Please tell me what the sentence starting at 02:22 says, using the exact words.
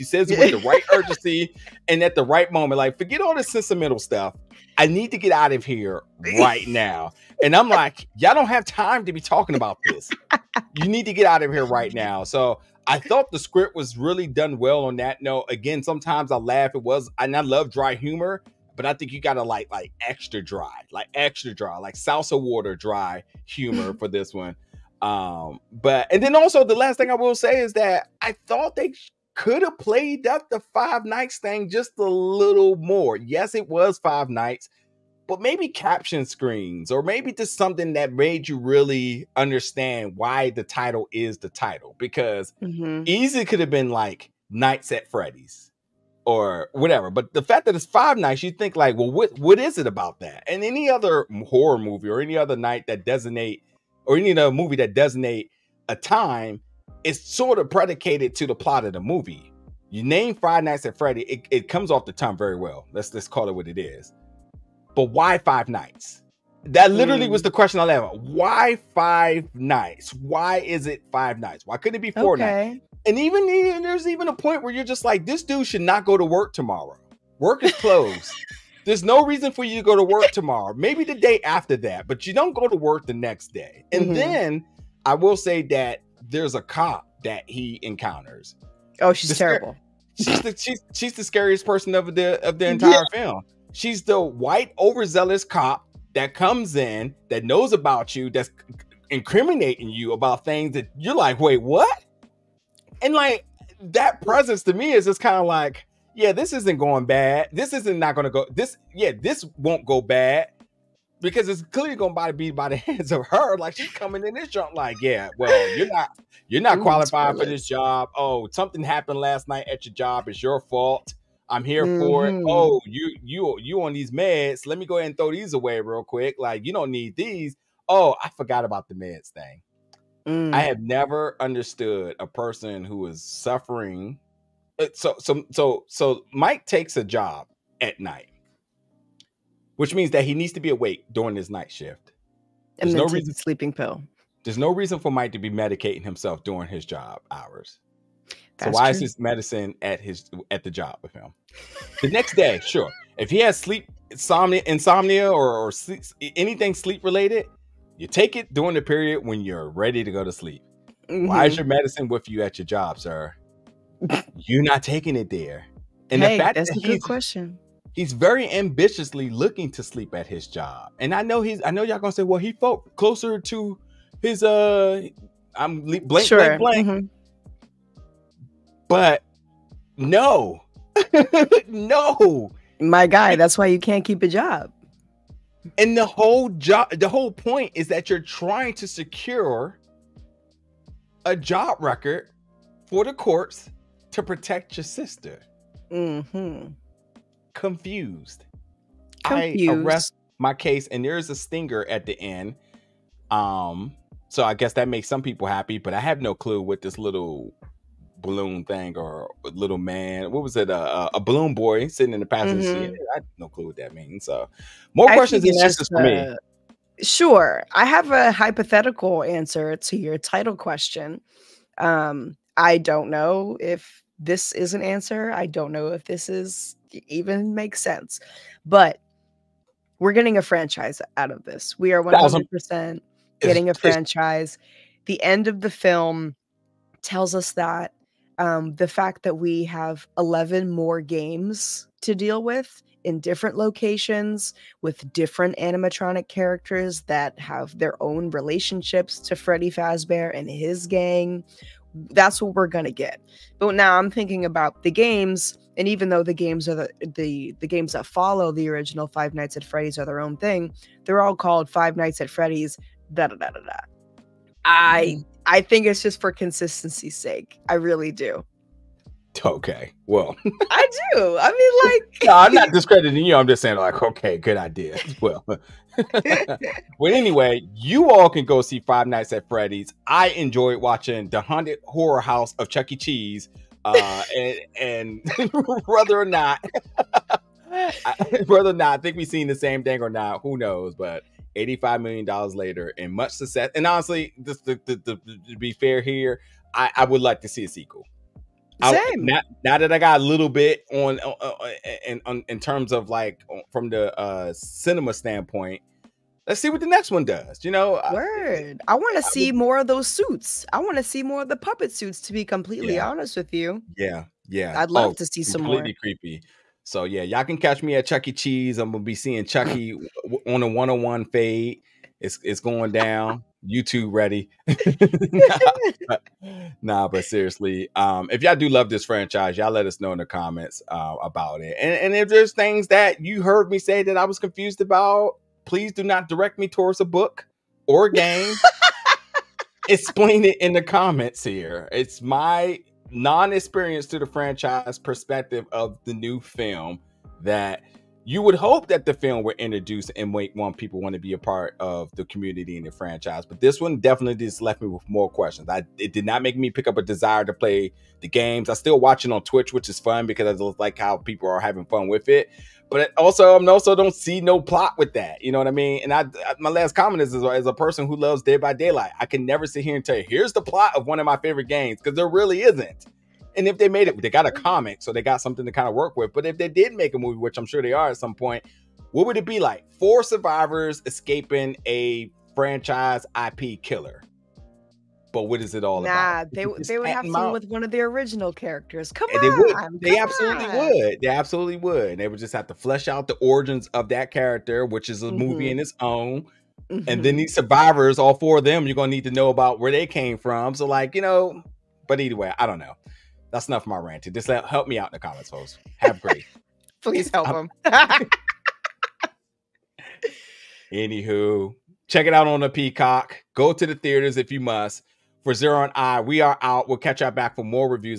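There's and no reason sleeping pill.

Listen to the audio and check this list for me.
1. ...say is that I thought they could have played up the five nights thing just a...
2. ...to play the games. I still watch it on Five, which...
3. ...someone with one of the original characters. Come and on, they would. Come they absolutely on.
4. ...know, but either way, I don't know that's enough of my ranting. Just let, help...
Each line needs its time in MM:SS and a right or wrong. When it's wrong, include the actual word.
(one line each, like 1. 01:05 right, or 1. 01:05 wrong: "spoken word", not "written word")
1. 00:27 right
2. 05:57 wrong: "Twitch", not "Five"
3. 06:27 right
4. 06:41 right.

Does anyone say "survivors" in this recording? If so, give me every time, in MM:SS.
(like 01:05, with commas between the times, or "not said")
06:20, 06:37.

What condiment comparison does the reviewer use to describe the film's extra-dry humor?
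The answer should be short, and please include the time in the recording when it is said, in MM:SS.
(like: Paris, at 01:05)
salsa water, at 00:21.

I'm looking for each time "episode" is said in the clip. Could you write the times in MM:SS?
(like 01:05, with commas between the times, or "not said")
not said.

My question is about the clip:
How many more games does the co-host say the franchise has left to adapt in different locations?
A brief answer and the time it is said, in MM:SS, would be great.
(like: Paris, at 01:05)
11, at 04:00.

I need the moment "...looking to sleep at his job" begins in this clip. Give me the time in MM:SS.
02:49.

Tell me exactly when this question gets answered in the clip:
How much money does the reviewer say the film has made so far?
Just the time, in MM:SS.
04:51.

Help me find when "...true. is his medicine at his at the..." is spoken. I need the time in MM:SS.
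02:28.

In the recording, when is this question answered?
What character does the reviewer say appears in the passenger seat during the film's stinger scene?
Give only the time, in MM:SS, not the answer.
03:31.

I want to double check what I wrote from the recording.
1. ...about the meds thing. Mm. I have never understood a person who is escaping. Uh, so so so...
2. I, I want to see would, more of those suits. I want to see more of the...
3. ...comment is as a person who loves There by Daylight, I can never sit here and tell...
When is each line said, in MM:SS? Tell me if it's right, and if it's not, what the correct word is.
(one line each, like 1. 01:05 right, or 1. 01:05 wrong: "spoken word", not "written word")
1. 02:08 wrong: "suffering", not "escaping"
2. 05:08 right
3. 06:06 wrong: "Dead", not "There".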